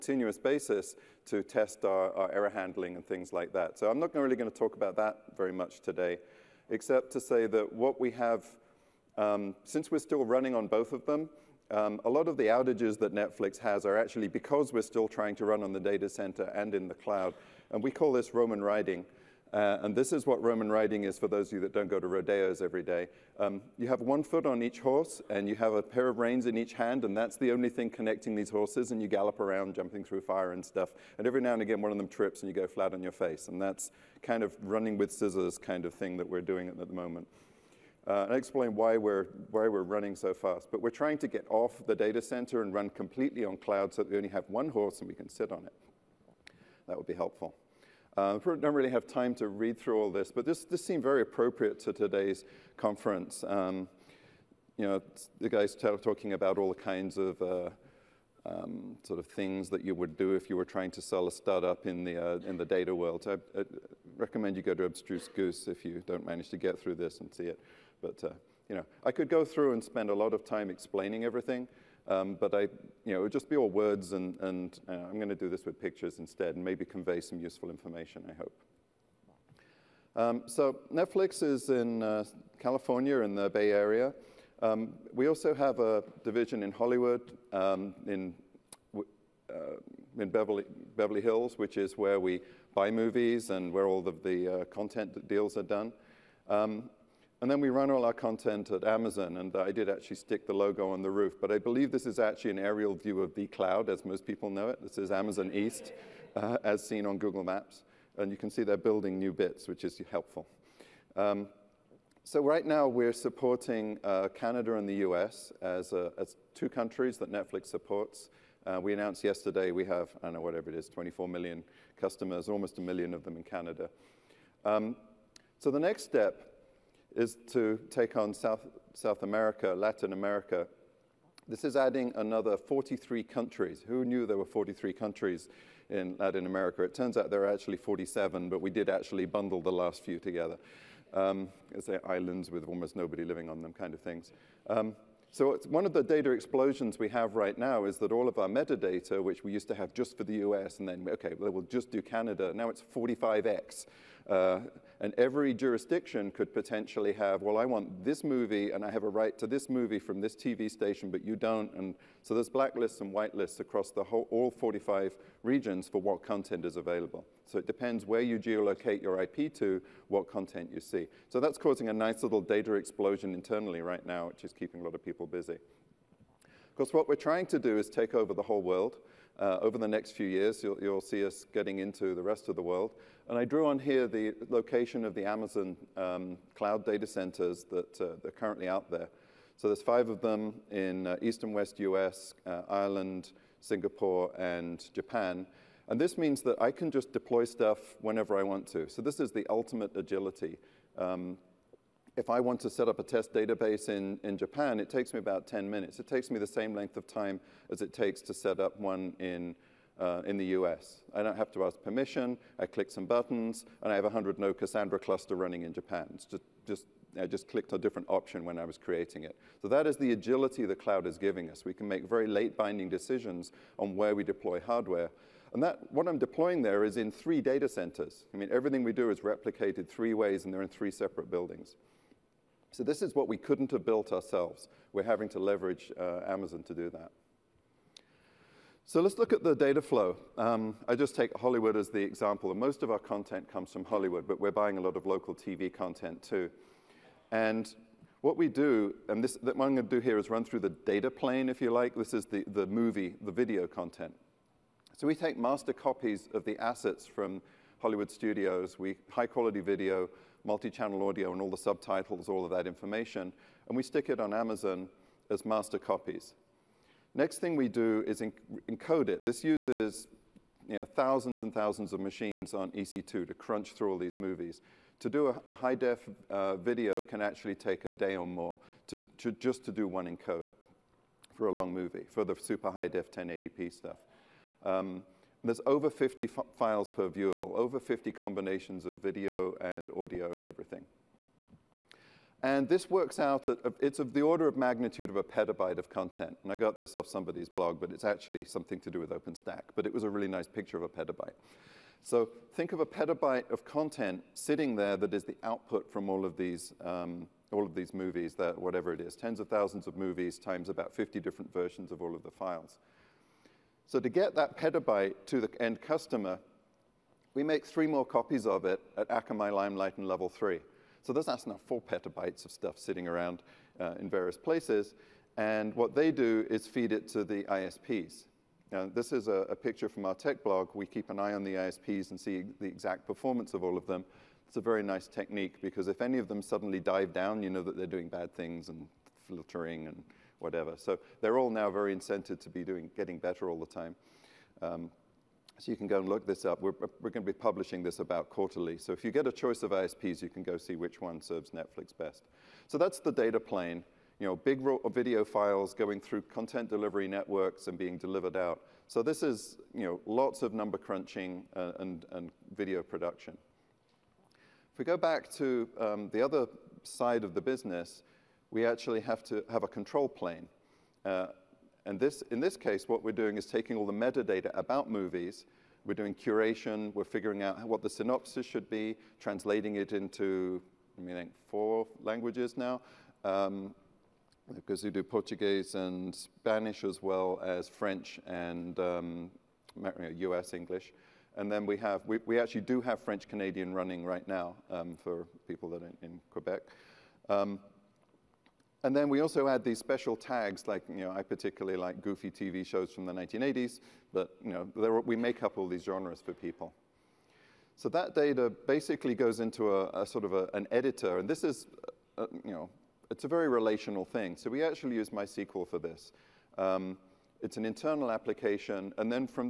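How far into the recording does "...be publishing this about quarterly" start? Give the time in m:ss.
5:47.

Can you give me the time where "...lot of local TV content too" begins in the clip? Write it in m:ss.
4:04.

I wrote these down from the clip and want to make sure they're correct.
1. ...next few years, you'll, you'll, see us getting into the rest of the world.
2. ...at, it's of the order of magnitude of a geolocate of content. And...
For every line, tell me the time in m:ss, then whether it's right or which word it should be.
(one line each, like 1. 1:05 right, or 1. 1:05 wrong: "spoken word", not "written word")
1. 2:59 right
2. 4:53 wrong: "petabyte", not "geolocate".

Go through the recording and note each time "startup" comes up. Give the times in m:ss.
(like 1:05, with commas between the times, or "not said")
1:01.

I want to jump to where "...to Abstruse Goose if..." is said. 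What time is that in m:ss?
1:04.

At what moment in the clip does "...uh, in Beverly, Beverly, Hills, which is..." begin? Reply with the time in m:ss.
1:28.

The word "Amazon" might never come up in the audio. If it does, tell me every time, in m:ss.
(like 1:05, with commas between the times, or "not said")
1:38, 1:45, 3:05, 3:56, 4:24.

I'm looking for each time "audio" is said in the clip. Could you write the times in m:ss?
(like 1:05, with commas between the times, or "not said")
4:21, 4:49.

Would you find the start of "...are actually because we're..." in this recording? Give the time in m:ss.
0:13.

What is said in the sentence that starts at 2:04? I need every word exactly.
Um, so the next step is to take on South, South America, Latin America.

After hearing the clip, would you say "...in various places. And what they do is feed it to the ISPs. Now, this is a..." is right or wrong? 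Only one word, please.
right.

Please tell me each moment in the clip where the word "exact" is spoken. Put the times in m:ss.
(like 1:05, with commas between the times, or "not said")
5:32.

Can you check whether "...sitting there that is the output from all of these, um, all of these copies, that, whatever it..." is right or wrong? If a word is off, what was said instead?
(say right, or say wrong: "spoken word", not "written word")
wrong: "movies", not "copies".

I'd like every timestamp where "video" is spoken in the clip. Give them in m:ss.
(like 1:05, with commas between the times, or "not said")
4:13, 4:19, 4:36, 4:49, 5:54, 6:02.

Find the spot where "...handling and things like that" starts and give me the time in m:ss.
0:02.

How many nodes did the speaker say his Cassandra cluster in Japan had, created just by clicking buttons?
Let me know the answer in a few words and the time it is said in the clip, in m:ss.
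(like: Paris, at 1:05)
100, at 3:34.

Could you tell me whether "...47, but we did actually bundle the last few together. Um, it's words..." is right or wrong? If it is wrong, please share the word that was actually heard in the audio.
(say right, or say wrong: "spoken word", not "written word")
wrong: "islands", not "words".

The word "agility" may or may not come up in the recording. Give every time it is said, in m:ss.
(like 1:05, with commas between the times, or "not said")
3:19, 3:40.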